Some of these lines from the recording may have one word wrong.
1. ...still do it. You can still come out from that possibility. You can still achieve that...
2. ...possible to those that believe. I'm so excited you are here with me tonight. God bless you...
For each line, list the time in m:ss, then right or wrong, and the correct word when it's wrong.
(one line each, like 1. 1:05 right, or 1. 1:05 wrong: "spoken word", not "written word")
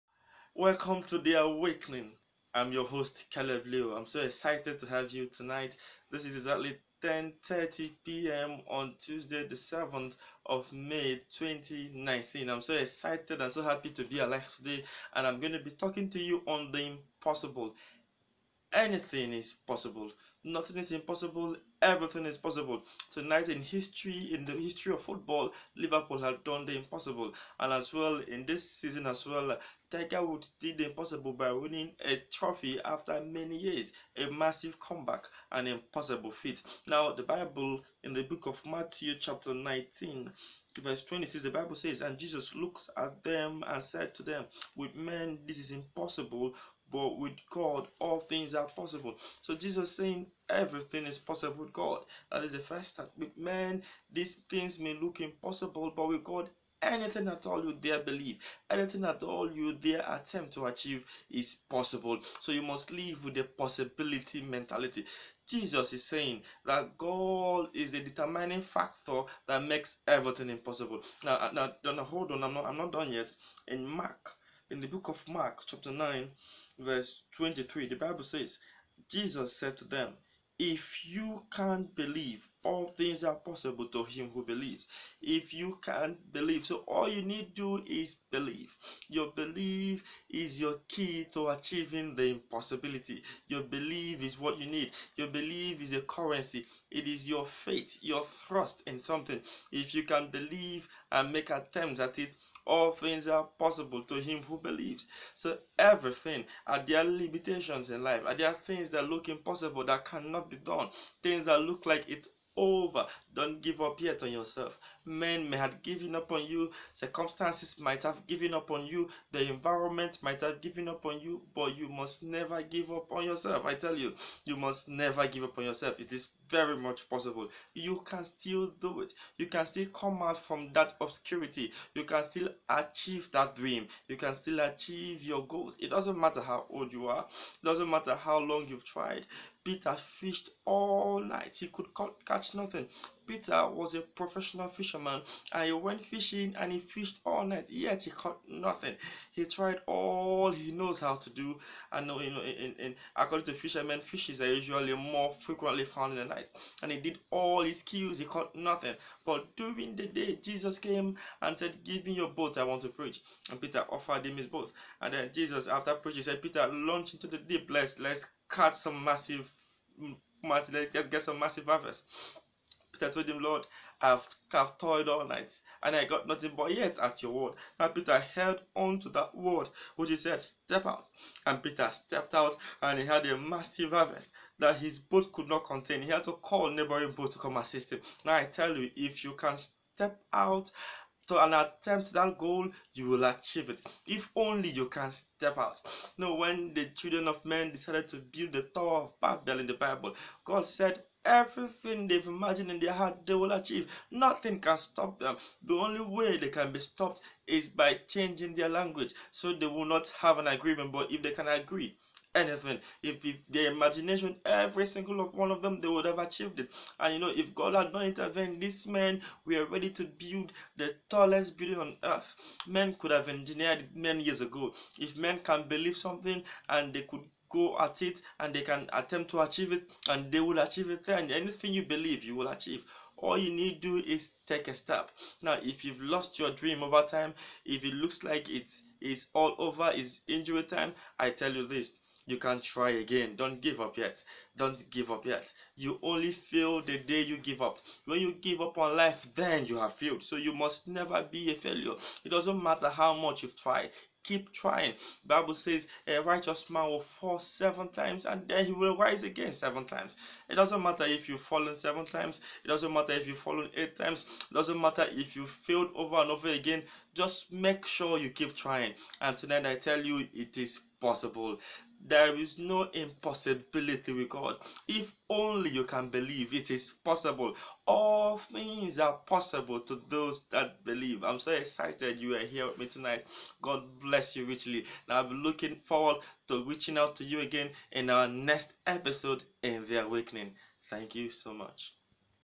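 1. 2:08 wrong: "obscurity", not "possibility"
2. 4:39 right.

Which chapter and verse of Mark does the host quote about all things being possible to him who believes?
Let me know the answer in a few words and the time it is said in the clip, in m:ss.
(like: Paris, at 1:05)
Chapter 9, verse 23, at 1:15.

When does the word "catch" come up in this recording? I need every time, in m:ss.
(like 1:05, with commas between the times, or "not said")
2:22, 2:48.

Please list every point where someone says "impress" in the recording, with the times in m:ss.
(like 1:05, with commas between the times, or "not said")
not said.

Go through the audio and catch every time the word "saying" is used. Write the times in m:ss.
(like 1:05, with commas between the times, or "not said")
0:49, 1:06.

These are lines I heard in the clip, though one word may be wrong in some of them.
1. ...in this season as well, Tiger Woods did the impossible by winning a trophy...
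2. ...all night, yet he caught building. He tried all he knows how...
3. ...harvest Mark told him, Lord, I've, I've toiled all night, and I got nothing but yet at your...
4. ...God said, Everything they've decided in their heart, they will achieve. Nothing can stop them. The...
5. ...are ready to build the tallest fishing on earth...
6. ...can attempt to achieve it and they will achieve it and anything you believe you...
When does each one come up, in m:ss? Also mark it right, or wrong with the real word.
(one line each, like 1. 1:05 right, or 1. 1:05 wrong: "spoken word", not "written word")
1. 0:28 right
2. 2:27 wrong: "nothing", not "building"
3. 2:51 wrong: "Peter", not "Mark"
4. 3:20 wrong: "imagined", not "decided"
5. 3:39 wrong: "building", not "fishing"
6. 3:48 right.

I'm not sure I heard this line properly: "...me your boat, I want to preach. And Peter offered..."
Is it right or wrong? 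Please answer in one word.
right.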